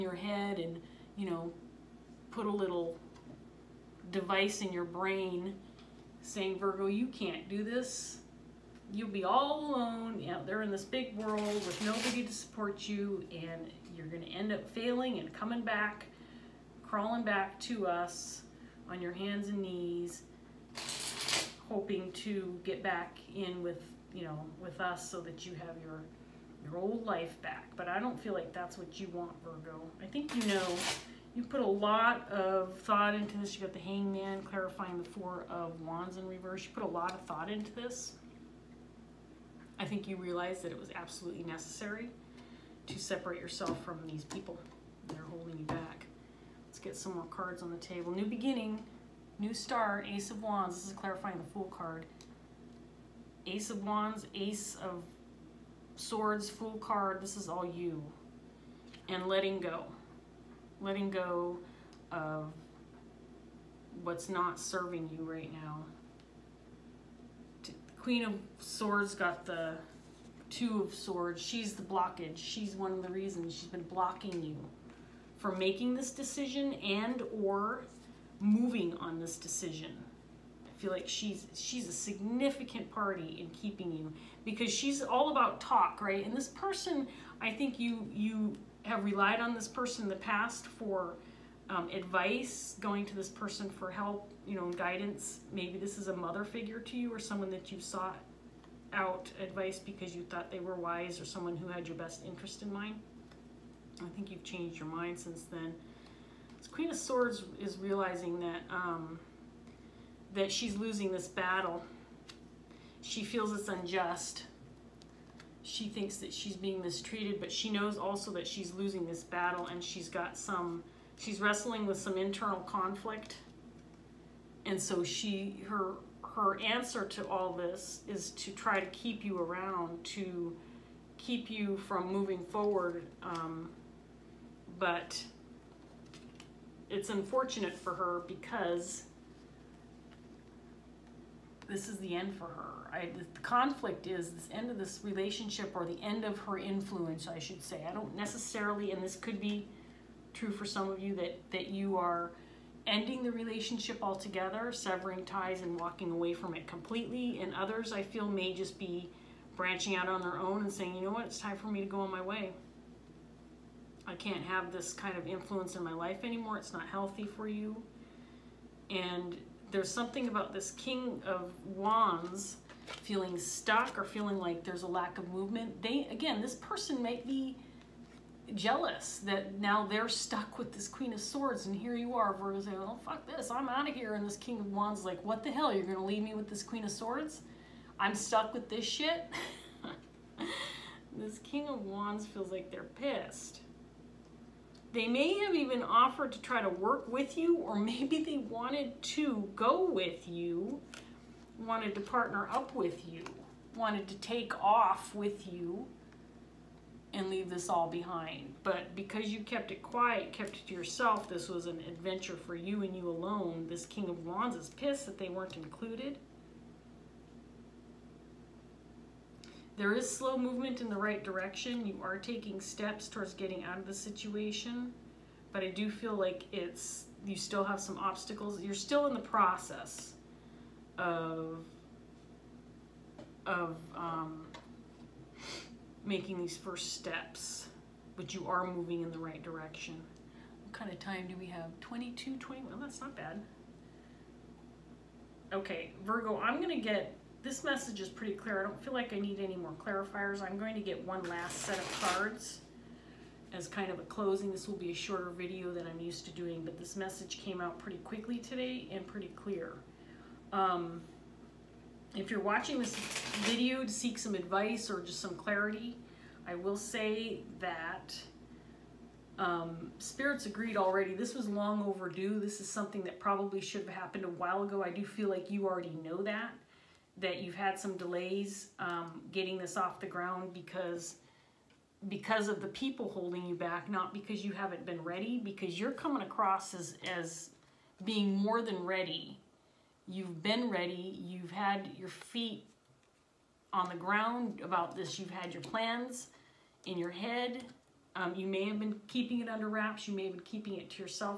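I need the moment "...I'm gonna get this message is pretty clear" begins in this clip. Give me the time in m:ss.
4:06.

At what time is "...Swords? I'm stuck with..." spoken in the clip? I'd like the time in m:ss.
3:06.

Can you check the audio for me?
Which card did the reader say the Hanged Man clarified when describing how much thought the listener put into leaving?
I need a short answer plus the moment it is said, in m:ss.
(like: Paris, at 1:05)
Four of Wands in reverse, at 0:35.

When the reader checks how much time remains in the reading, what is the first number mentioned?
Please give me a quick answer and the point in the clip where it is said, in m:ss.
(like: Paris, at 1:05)
22, at 4:01.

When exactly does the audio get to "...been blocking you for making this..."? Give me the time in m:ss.
1:13.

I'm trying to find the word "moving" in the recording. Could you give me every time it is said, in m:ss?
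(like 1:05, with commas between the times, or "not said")
1:18, 2:12, 3:58.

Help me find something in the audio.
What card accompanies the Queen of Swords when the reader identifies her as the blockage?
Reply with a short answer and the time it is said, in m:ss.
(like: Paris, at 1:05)
Two of Swords, at 1:10.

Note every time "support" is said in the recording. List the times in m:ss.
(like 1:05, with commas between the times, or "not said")
0:12.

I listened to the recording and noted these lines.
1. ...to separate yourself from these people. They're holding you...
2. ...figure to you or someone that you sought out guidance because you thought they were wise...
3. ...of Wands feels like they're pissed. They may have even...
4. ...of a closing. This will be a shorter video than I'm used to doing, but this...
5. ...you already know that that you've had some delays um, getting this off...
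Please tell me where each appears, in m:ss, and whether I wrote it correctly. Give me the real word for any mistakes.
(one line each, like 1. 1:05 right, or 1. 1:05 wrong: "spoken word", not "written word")
1. 0:42 right
2. 1:36 wrong: "advice", not "guidance"
3. 3:11 right
4. 4:13 right
5. 4:35 right.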